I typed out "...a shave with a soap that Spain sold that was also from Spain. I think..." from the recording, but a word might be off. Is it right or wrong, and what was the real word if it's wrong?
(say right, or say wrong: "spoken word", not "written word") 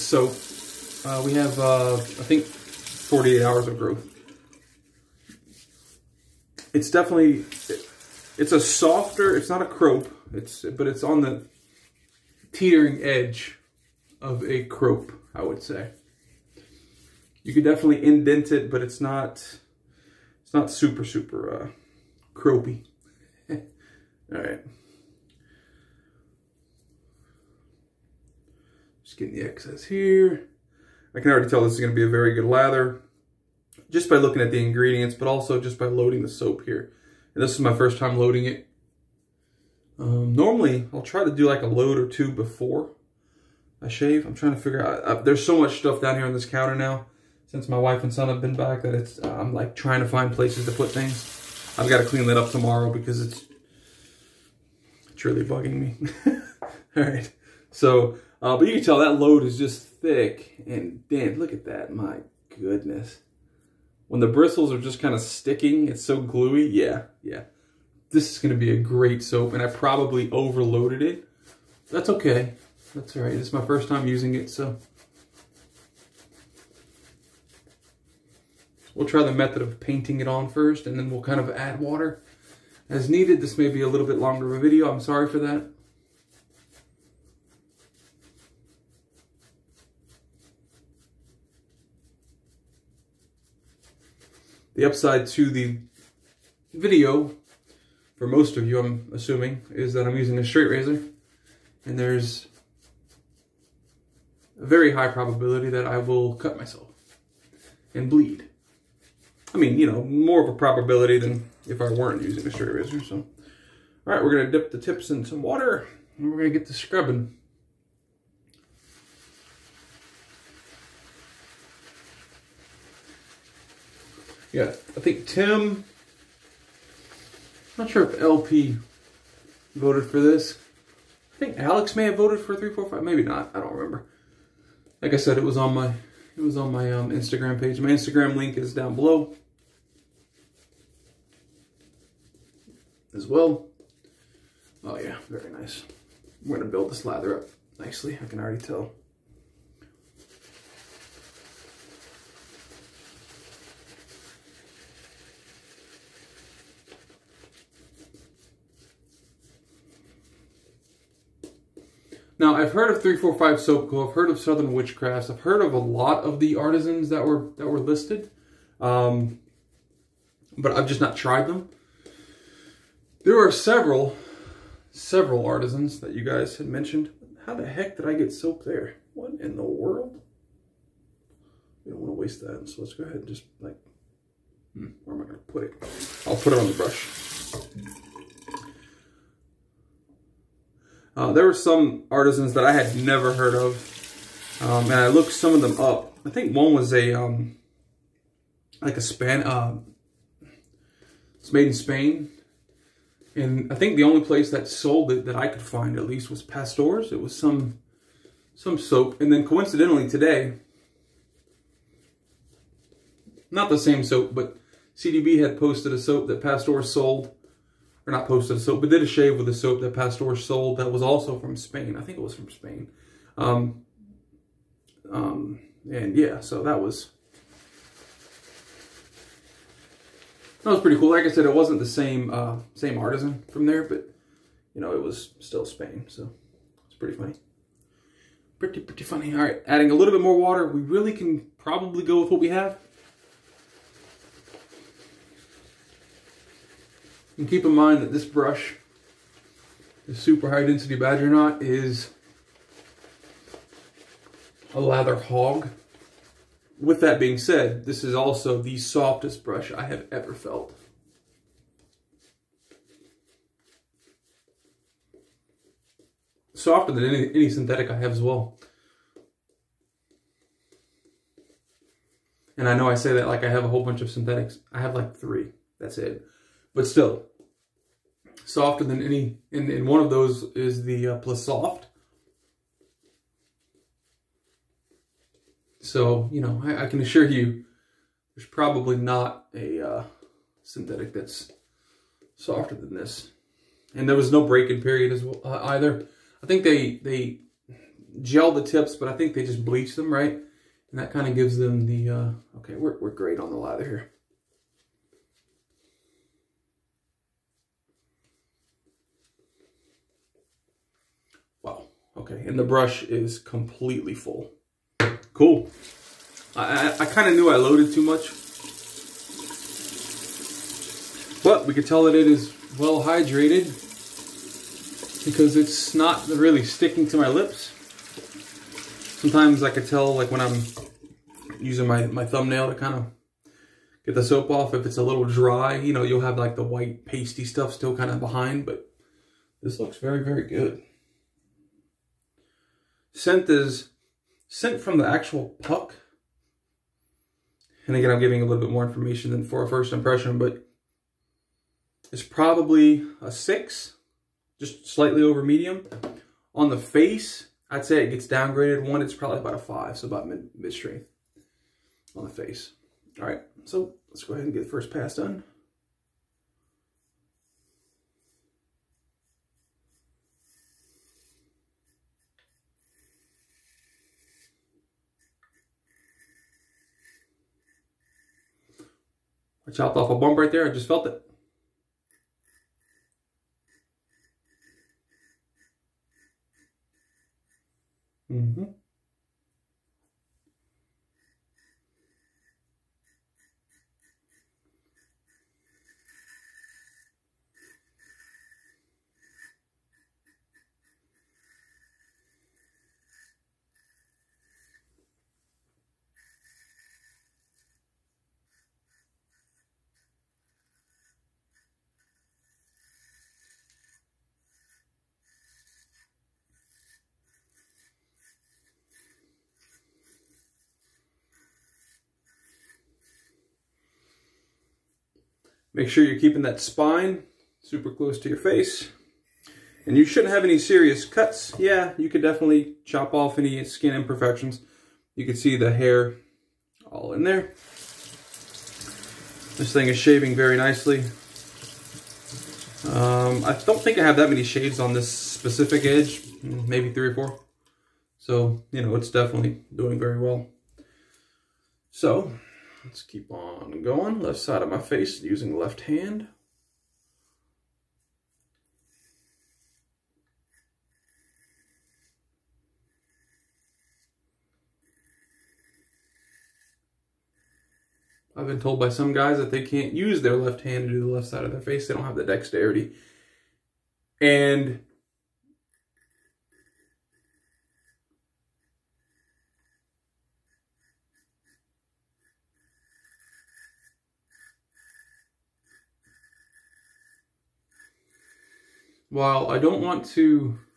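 wrong: "Pasteur", not "Spain".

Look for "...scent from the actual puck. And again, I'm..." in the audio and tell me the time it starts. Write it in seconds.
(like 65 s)
344 s.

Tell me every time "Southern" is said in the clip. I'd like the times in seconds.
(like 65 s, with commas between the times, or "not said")
164 s.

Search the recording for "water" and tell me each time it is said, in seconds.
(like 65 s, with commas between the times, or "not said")
81 s, 115 s, 240 s.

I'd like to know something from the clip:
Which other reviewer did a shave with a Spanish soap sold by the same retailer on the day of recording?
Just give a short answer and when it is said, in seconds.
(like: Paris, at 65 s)
CDB, at 214 s.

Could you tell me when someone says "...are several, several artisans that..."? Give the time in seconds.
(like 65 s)
173 s.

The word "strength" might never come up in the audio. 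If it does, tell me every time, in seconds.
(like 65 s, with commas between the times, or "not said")
360 s.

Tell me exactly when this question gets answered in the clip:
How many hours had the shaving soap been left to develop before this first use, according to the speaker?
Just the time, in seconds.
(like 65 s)
2 s.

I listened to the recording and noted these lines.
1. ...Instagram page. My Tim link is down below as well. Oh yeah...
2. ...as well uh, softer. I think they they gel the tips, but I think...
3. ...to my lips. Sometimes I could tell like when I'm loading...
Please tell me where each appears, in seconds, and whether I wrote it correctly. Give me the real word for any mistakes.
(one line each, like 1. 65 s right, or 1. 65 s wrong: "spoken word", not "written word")
1. 137 s wrong: "Instagram", not "Tim"
2. 295 s wrong: "either", not "softer"
3. 327 s wrong: "using", not "loading".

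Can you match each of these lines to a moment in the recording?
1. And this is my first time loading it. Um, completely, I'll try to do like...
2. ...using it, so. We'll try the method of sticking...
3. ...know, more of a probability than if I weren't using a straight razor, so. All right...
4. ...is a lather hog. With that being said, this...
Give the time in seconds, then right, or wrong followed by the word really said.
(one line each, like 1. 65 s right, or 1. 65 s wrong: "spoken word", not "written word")
1. 37 s wrong: "normally", not "completely"
2. 74 s wrong: "painting", not "sticking"
3. 109 s right
4. 251 s right.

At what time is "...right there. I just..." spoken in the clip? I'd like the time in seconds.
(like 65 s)
380 s.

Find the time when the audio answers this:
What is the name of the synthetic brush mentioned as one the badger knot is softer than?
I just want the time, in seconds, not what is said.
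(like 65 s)
281 s.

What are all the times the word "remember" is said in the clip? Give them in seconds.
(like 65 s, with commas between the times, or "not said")
133 s.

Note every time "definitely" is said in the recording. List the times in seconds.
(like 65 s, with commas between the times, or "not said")
6 s, 17 s, 432 s, 449 s.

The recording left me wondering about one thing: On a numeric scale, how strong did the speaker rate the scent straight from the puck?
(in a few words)
6.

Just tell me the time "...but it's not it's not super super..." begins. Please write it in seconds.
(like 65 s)
18 s.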